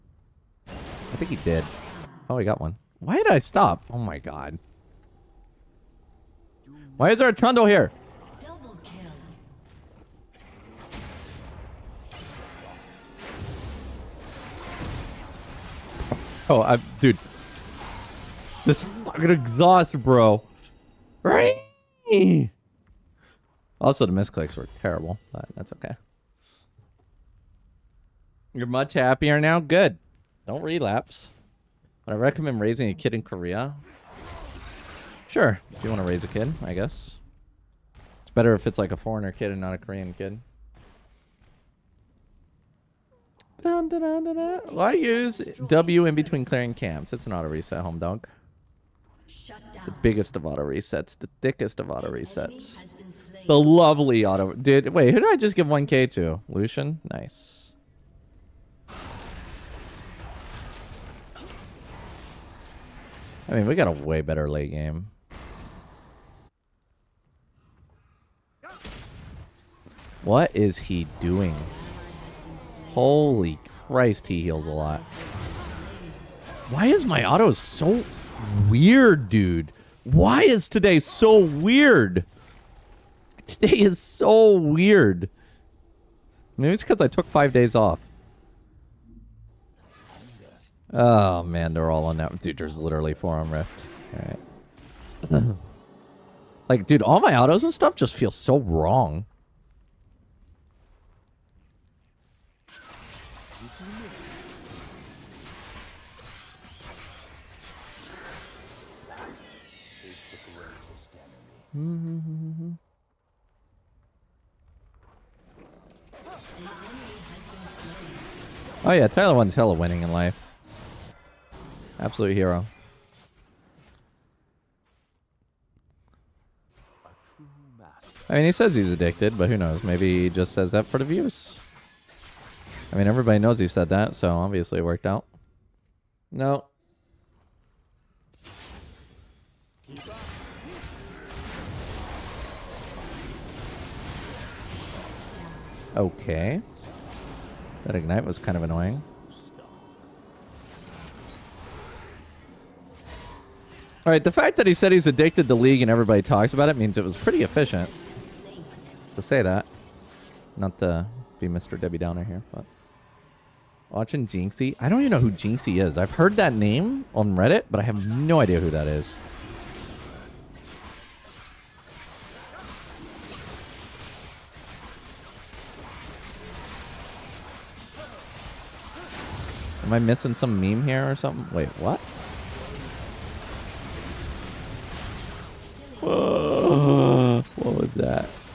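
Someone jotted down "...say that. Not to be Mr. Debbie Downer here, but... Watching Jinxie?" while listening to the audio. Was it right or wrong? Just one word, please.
right.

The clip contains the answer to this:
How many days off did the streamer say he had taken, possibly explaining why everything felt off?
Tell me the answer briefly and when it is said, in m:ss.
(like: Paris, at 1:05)
5, at 1:27.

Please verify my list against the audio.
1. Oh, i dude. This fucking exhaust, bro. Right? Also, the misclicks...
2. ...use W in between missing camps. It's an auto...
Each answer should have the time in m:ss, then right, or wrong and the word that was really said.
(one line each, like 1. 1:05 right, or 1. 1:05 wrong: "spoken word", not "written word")
1. 0:16 right
2. 0:44 wrong: "clearing", not "missing".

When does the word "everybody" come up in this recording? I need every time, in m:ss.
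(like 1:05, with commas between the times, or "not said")
2:13, 2:35.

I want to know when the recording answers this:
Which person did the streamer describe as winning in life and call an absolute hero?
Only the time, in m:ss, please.
1:59.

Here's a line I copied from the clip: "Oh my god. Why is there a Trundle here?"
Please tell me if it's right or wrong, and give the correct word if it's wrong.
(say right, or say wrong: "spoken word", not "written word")
right.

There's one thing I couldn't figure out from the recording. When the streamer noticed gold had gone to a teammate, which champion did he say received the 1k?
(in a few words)
Lucian.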